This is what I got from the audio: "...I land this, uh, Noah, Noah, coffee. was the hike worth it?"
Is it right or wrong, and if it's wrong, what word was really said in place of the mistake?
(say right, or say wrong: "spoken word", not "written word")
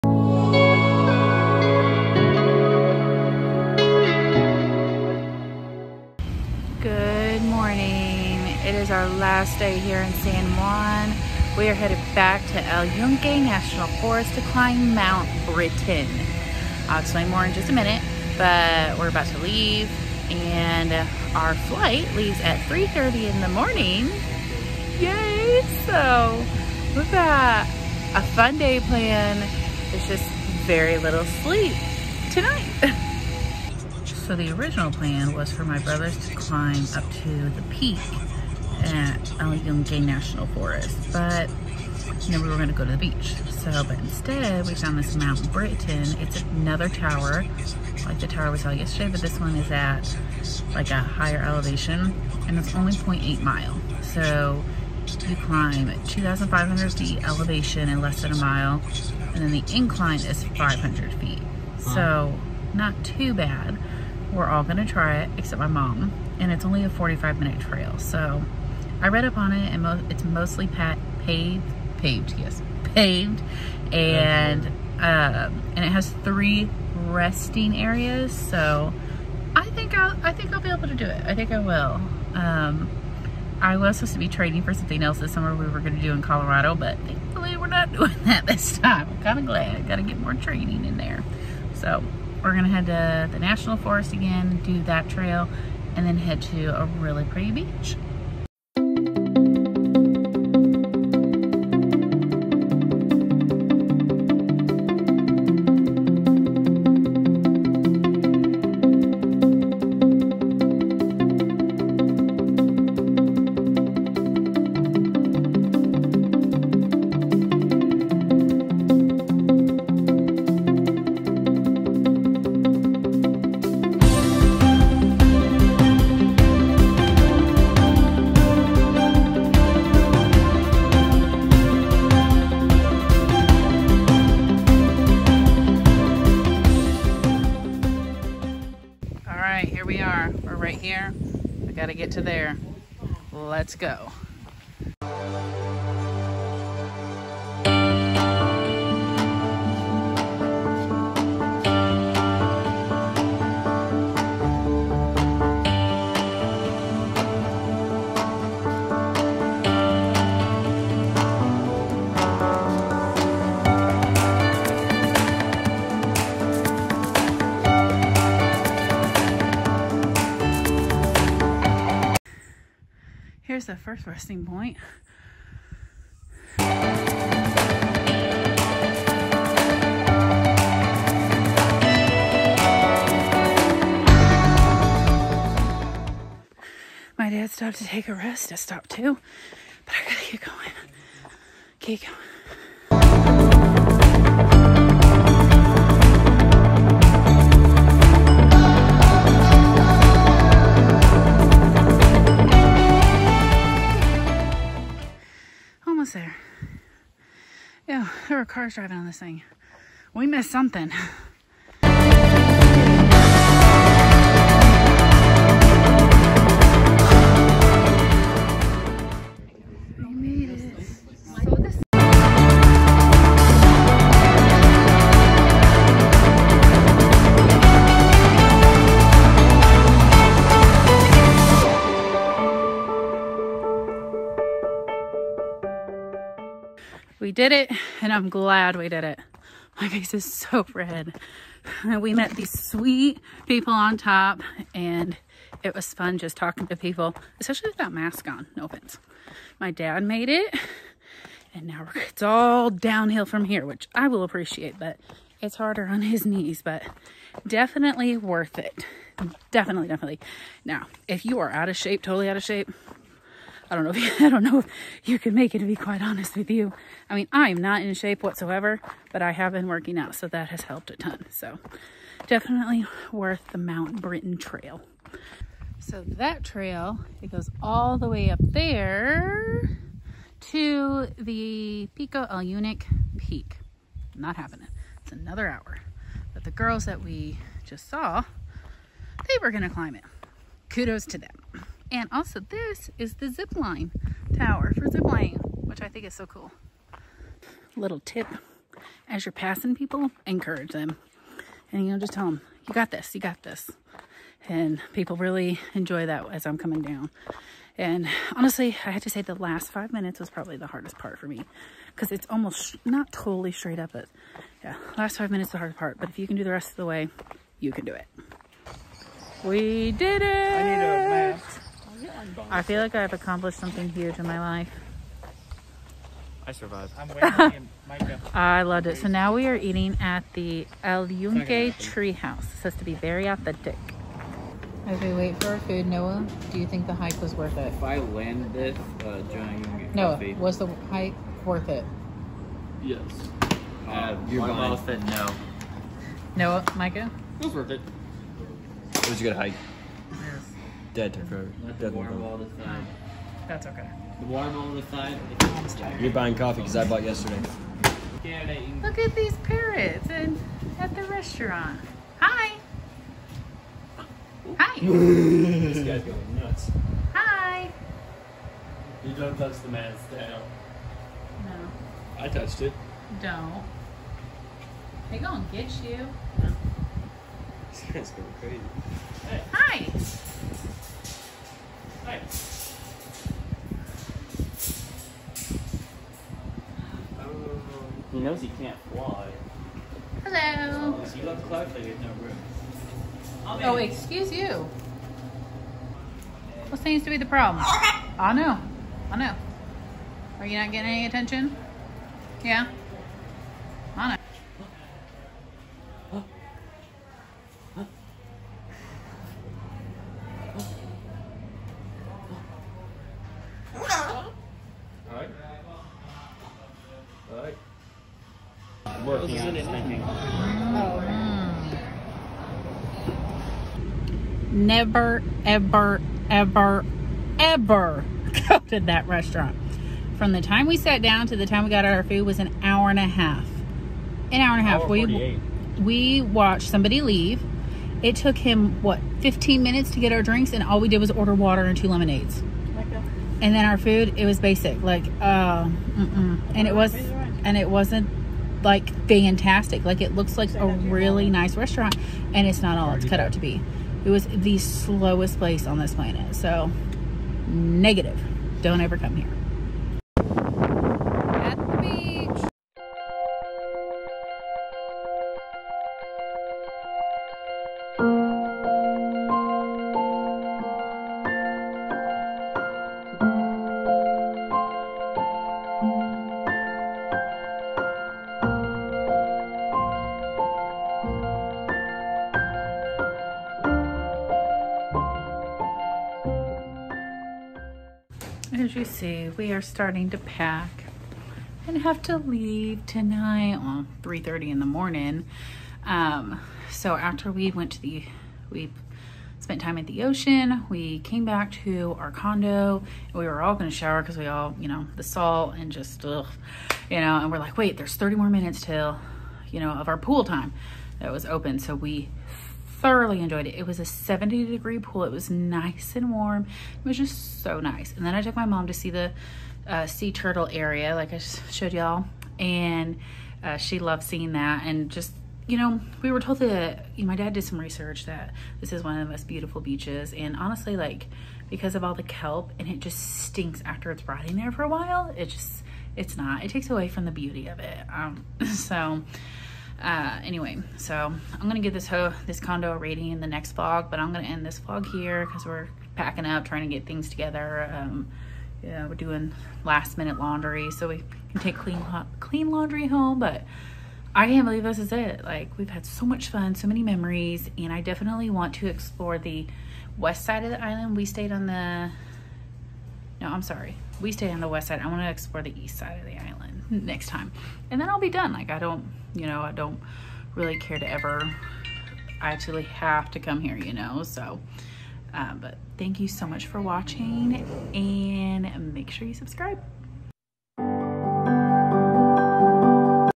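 wrong: "John", not "Noah".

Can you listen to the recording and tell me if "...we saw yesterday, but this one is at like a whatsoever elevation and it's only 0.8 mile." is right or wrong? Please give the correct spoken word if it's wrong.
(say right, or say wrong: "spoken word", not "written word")
wrong: "higher", not "whatsoever".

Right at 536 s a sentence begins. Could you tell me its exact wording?
It takes away from the beauty of it.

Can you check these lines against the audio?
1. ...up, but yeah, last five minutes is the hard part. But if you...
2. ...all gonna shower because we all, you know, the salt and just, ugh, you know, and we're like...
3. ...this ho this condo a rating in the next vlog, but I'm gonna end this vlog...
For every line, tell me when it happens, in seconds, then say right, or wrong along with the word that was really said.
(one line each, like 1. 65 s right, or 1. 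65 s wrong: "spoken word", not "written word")
1. 313 s right
2. 503 s right
3. 541 s right.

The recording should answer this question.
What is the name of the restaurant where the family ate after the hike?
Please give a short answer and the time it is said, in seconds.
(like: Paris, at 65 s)
El Yunque Tree House, at 330 s.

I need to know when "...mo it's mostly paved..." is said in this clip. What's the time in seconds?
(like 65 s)
69 s.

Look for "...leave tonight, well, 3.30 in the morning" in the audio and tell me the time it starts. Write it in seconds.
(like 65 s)
492 s.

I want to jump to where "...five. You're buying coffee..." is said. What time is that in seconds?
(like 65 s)
354 s.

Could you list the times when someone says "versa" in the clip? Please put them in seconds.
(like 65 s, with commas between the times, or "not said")
not said.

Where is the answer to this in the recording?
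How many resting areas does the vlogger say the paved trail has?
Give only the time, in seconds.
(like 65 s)
76 s.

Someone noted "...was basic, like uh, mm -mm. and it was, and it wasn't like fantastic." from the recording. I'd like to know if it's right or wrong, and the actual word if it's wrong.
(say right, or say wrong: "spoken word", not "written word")
right.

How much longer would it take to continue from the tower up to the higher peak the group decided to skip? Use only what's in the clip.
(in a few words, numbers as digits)
1 hour.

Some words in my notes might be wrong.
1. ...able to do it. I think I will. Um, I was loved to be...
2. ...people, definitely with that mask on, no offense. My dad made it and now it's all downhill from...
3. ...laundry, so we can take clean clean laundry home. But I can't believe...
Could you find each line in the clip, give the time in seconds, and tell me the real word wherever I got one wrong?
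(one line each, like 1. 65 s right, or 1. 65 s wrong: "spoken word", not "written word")
1. 80 s wrong: "supposed", not "loved"
2. 246 s wrong: "especially", not "definitely"
3. 550 s right.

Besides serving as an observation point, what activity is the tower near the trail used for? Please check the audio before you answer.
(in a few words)
Zip lining.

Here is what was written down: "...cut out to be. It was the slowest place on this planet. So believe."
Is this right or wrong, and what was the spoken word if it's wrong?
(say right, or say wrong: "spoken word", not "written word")
wrong: "negative", not "believe".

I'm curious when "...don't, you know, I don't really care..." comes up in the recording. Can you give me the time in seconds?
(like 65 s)
568 s.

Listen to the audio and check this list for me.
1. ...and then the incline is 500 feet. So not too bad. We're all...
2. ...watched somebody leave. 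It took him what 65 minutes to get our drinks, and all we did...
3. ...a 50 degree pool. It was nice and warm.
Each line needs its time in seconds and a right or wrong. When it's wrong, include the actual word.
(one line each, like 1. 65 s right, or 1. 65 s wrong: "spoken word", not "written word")
1. 59 s right
2. 436 s wrong: "15", not "65"
3. 513 s wrong: "70", not "50".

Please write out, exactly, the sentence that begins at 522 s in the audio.
And uh, she loved seeing that.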